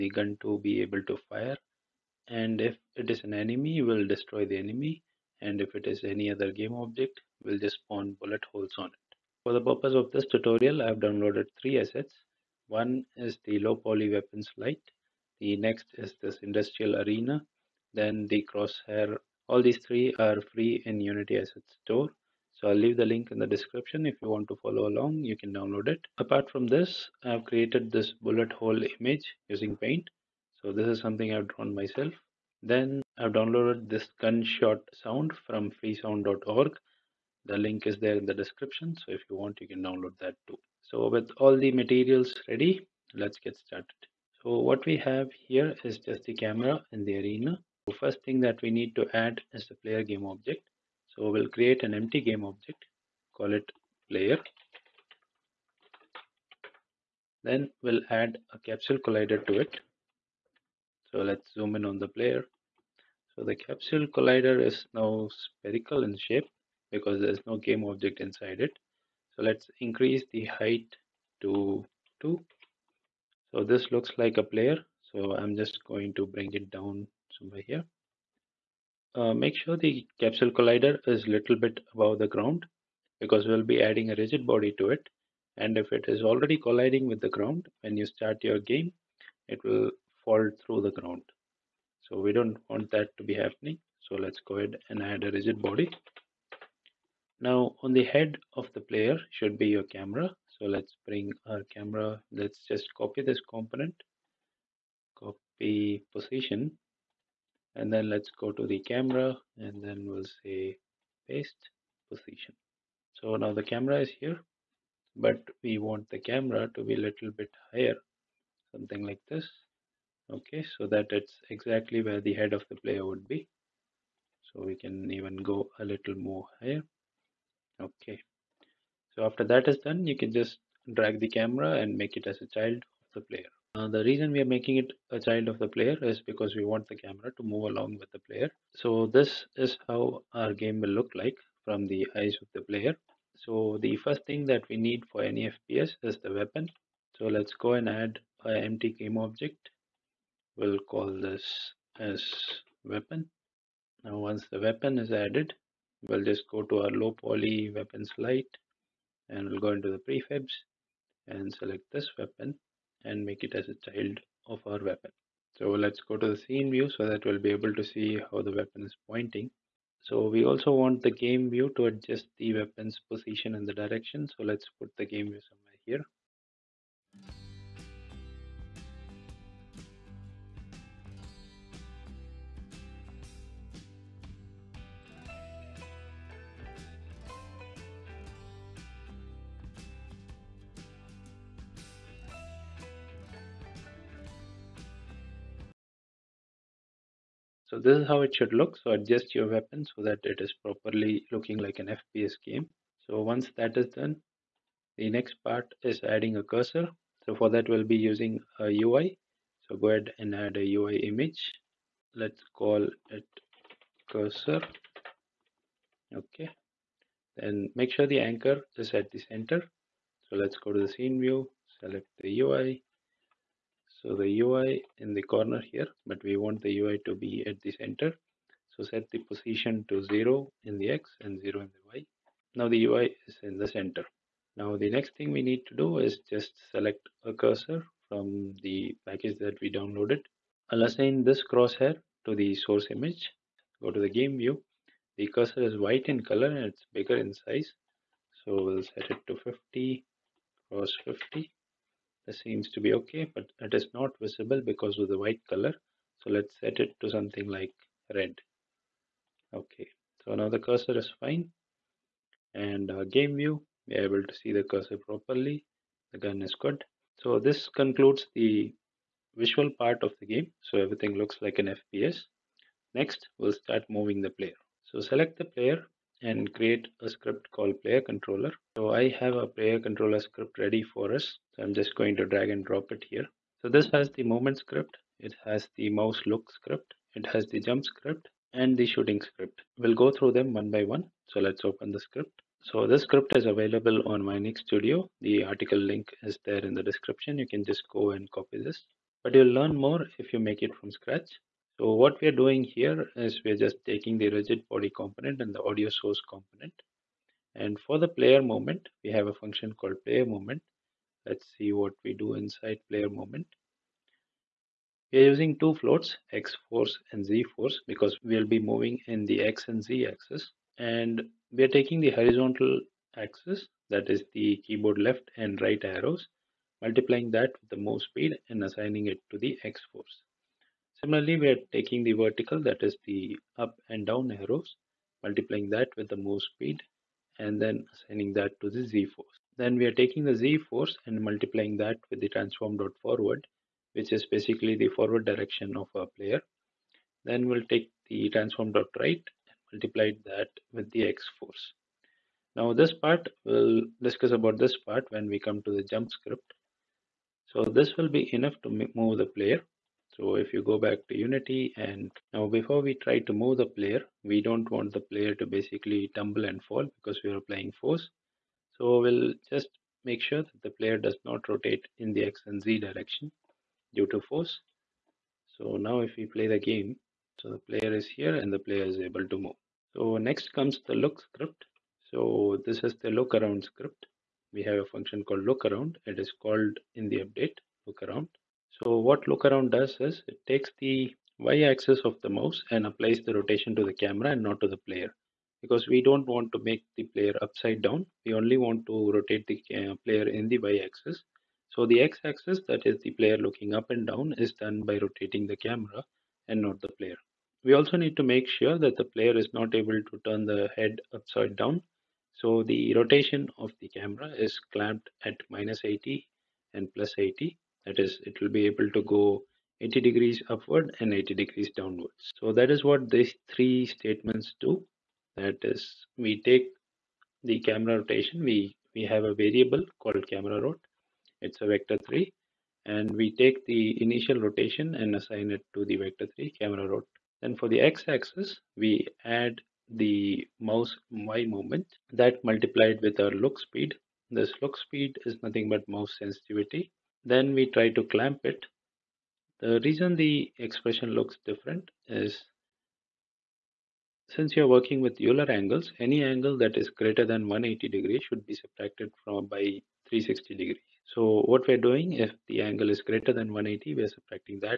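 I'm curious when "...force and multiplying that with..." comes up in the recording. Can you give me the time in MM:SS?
05:40.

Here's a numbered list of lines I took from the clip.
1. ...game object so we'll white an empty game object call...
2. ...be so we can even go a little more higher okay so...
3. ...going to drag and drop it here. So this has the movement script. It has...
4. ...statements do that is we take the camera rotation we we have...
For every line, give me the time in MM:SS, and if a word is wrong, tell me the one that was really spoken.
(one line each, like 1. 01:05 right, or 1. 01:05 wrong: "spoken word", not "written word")
1. 00:50 wrong: "create", not "white"
2. 02:03 right
3. 04:41 right
4. 07:03 right.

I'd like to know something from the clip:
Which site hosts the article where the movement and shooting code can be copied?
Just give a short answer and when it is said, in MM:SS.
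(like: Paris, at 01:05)
Vionix Studio, at 04:54.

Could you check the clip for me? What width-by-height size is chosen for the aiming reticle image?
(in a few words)
50 x 50.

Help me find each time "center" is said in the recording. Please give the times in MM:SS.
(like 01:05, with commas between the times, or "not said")
03:39, 03:47, 03:53.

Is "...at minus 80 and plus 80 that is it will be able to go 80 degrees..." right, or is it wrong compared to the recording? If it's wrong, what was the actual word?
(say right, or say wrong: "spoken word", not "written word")
right.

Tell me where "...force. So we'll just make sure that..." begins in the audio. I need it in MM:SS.
06:07.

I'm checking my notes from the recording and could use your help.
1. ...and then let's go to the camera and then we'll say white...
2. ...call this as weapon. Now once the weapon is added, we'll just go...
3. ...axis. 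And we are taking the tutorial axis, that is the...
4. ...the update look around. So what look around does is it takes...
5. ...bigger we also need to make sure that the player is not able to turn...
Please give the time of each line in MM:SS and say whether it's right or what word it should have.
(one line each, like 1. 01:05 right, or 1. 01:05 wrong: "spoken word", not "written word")
1. 01:47 wrong: "paste", not "white"
2. 02:30 right
3. 05:20 wrong: "horizontal", not "tutorial"
4. 06:27 right
5. 06:46 wrong: "player", not "bigger".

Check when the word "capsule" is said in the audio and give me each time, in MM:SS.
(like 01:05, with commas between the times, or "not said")
00:58, 01:03, 01:20.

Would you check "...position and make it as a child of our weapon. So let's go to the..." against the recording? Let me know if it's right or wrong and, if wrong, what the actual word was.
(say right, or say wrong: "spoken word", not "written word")
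wrong: "weapon", not "position".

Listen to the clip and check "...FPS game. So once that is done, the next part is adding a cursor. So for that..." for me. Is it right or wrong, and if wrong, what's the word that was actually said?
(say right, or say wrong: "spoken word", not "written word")
right.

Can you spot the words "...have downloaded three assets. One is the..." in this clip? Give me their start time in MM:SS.
00:10.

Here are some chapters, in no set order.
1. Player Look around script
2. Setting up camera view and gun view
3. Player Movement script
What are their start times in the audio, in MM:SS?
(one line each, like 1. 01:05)
1. 06:19
2. 00:43
3. 04:31.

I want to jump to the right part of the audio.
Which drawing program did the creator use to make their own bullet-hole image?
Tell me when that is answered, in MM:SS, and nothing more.
00:29.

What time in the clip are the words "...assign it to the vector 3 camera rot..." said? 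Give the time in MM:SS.
07:15.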